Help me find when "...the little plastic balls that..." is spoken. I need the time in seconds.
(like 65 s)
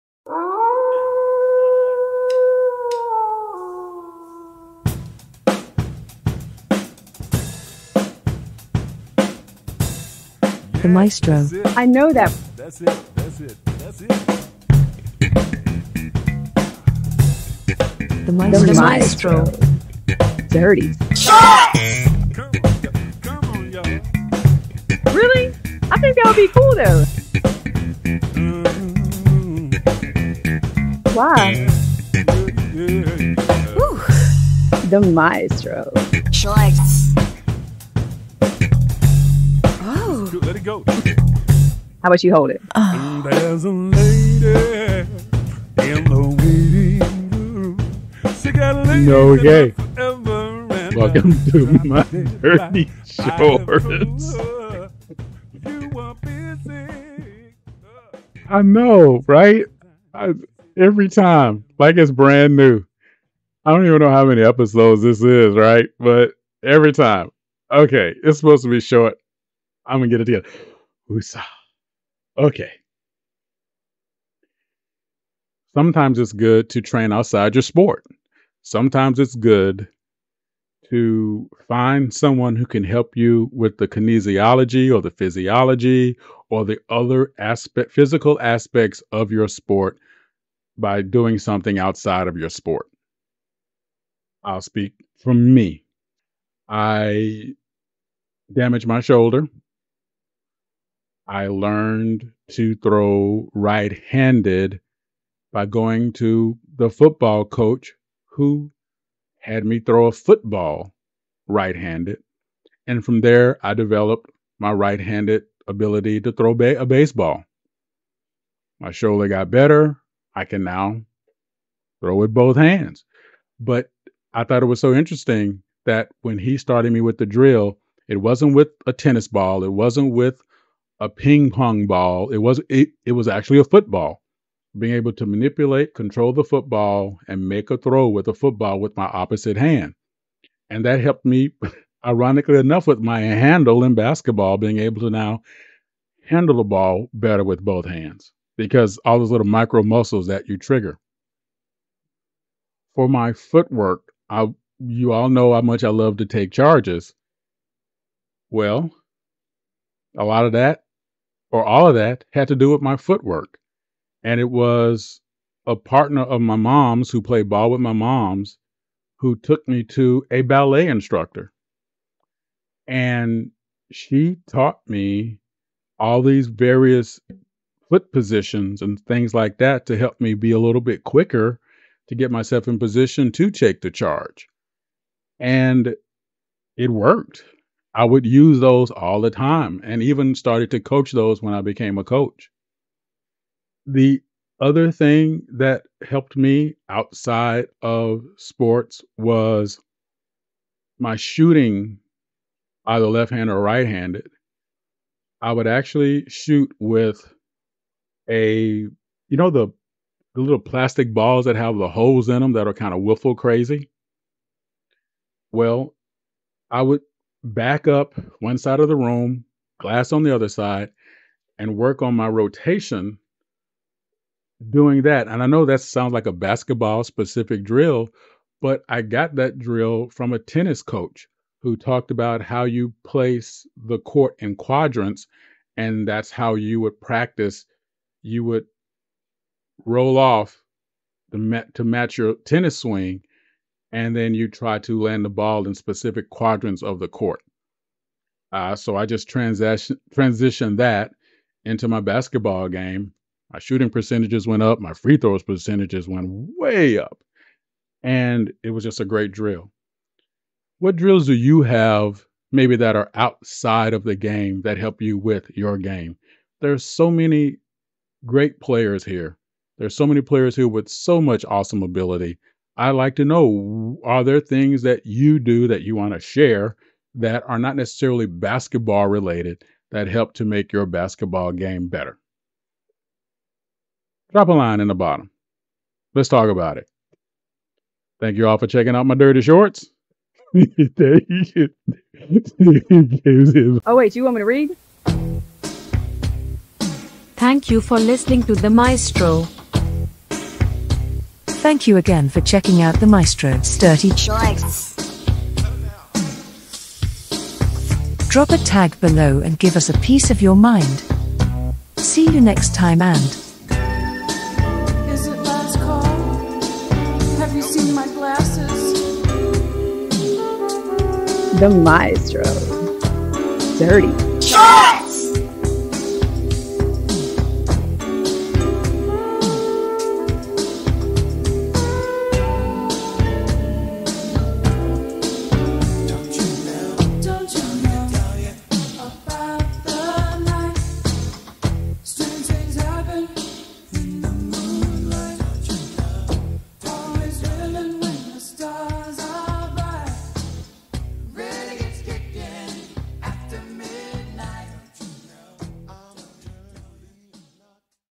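210 s.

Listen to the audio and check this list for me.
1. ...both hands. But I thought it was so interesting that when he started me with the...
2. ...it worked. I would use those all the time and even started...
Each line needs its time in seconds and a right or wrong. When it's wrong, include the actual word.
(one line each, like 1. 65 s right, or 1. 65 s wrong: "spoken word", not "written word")
1. 122 s right
2. 186 s right.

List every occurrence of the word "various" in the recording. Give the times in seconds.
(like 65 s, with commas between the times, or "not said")
176 s.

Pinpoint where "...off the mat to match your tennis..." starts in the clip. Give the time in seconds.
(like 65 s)
240 s.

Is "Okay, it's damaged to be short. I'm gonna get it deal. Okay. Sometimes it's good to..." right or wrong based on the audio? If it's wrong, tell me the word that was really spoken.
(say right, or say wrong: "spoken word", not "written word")
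wrong: "supposed", not "damaged".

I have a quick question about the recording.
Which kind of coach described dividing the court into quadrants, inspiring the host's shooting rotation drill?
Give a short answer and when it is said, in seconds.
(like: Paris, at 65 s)
A tennis coach, at 230 s.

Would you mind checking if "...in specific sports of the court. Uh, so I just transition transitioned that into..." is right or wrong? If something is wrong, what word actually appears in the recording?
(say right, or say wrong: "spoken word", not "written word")
wrong: "quadrants", not "sports".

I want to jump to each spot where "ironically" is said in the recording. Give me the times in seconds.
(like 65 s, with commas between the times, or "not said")
142 s.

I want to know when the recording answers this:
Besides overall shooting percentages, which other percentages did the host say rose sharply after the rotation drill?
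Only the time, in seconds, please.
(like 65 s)
254 s.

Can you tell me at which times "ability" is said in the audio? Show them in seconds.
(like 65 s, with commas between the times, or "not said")
115 s, 271 s.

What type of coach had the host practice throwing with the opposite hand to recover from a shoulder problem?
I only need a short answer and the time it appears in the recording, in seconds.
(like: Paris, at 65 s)
The football coach, at 106 s.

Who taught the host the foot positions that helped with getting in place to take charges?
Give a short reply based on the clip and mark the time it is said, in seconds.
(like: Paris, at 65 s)
A ballet instructor, at 170 s.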